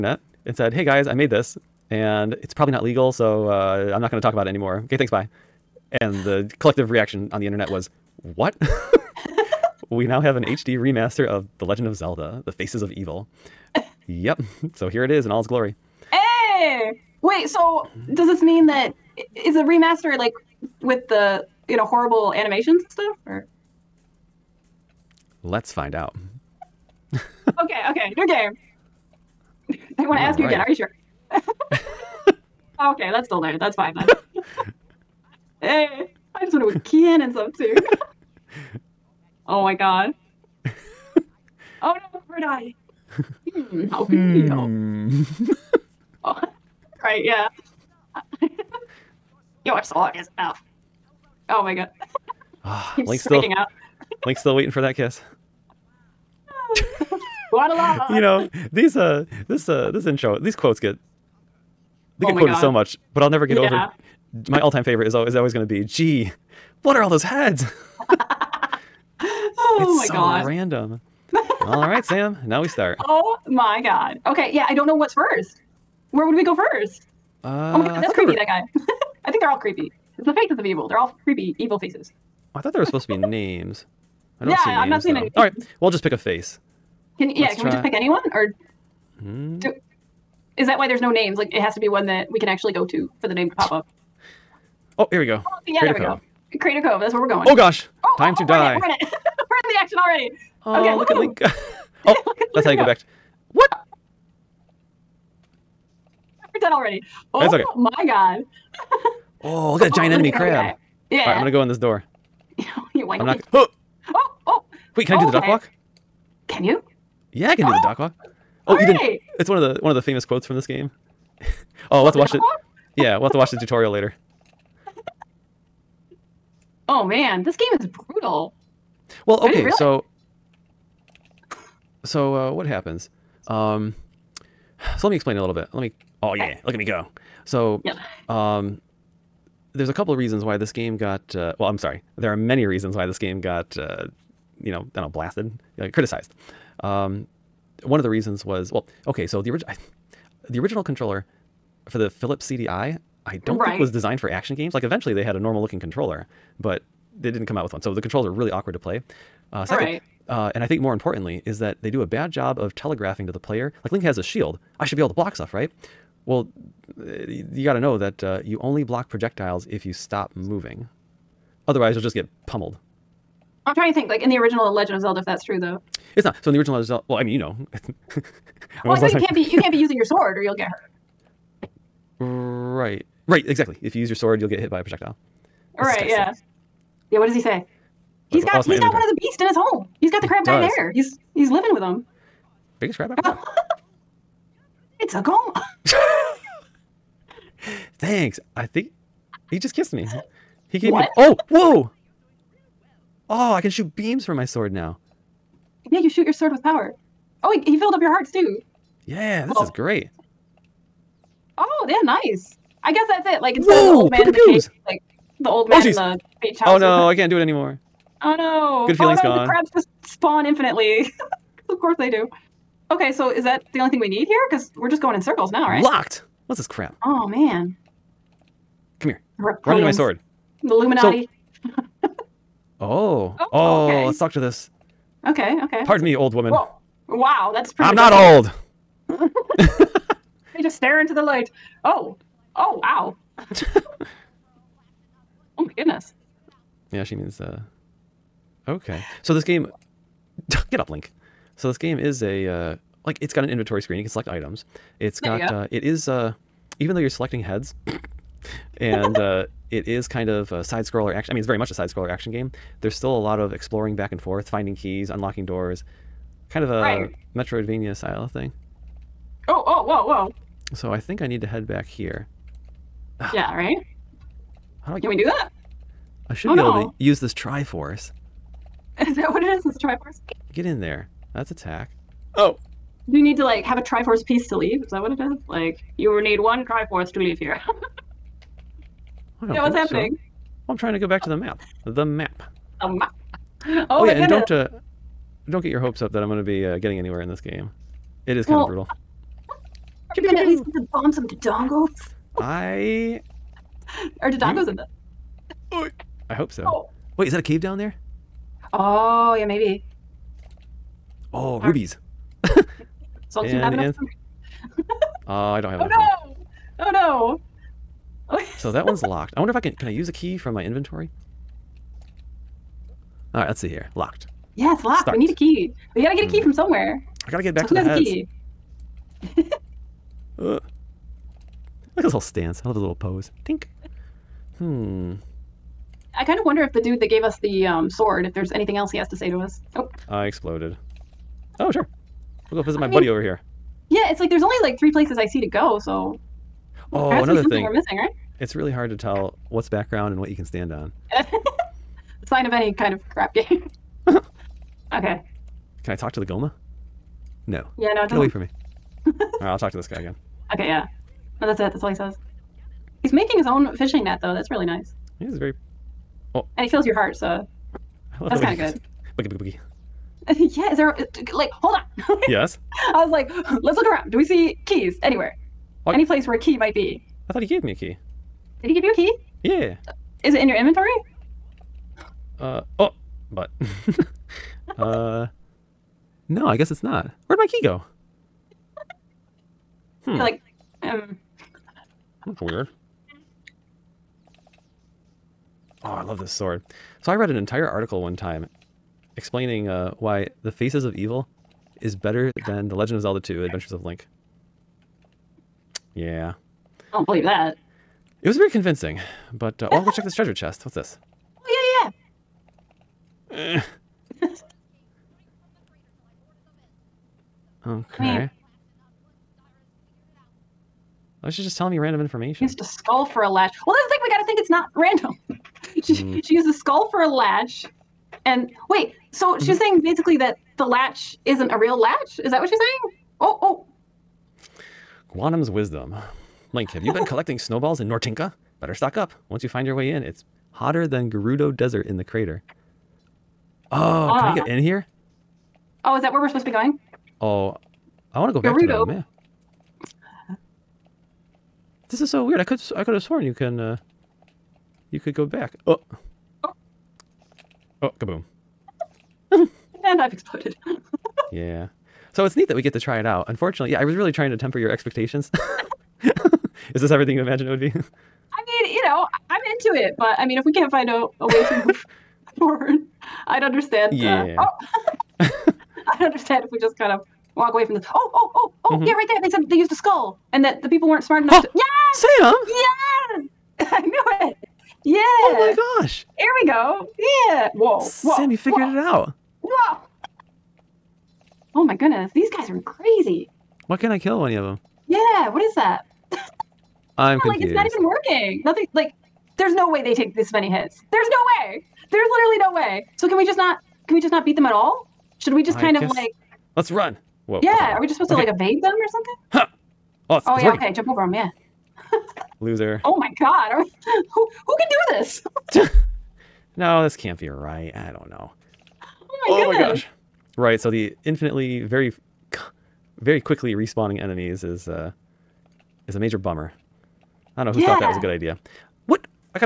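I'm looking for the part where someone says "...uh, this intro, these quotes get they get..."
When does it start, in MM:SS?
00:59.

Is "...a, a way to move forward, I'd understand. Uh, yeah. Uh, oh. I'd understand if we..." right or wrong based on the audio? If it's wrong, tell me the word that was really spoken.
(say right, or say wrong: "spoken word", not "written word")
right.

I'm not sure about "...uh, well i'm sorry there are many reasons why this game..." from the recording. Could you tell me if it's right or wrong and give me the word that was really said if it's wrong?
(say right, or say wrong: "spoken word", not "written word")
right.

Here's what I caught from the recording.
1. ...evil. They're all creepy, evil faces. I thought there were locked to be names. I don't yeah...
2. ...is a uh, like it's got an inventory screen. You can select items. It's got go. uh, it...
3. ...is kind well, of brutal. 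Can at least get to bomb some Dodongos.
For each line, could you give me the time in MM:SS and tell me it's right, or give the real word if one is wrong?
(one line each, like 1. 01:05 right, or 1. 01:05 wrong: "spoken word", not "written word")
1. 01:20 wrong: "supposed", not "locked"
2. 04:11 right
3. 04:58 right.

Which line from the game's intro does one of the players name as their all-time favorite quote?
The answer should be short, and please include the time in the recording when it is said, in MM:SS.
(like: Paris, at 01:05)
Gee, what are all those heads?, at 01:05.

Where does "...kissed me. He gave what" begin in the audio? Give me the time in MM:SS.
03:19.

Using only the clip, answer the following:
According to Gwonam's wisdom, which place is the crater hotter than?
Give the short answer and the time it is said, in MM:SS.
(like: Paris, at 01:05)
Gerudo Desert, at 07:21.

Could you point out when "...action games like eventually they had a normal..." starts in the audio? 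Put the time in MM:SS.
02:34.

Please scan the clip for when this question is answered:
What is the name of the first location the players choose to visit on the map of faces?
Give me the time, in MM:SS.
01:36.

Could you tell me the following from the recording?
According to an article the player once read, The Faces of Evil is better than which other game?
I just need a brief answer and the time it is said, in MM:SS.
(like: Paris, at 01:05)
Zelda 2: Adventures of Link, at 06:42.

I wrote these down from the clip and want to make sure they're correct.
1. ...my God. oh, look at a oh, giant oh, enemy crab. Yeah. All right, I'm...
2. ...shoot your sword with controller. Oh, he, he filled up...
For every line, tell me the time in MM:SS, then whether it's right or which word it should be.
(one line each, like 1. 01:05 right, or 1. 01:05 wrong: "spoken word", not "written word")
1. 01:47 right
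2. 03:26 wrong: "power", not "controller".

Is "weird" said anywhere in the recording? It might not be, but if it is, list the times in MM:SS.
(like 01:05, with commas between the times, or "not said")
06:32, 07:32.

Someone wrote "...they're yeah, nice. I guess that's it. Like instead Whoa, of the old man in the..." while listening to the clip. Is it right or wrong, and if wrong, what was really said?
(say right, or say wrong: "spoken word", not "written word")
right.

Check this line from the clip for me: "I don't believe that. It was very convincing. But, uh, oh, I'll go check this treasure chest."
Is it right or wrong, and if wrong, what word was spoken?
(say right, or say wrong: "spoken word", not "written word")
right.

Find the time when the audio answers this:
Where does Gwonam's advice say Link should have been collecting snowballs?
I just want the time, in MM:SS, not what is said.
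07:17.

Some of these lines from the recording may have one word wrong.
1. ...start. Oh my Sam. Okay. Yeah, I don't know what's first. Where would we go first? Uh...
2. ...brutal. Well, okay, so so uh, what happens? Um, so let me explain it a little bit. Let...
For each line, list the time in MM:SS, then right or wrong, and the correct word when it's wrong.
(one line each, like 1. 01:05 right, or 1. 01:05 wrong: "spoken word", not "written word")
1. 01:12 wrong: "God", not "Sam"
2. 02:07 right.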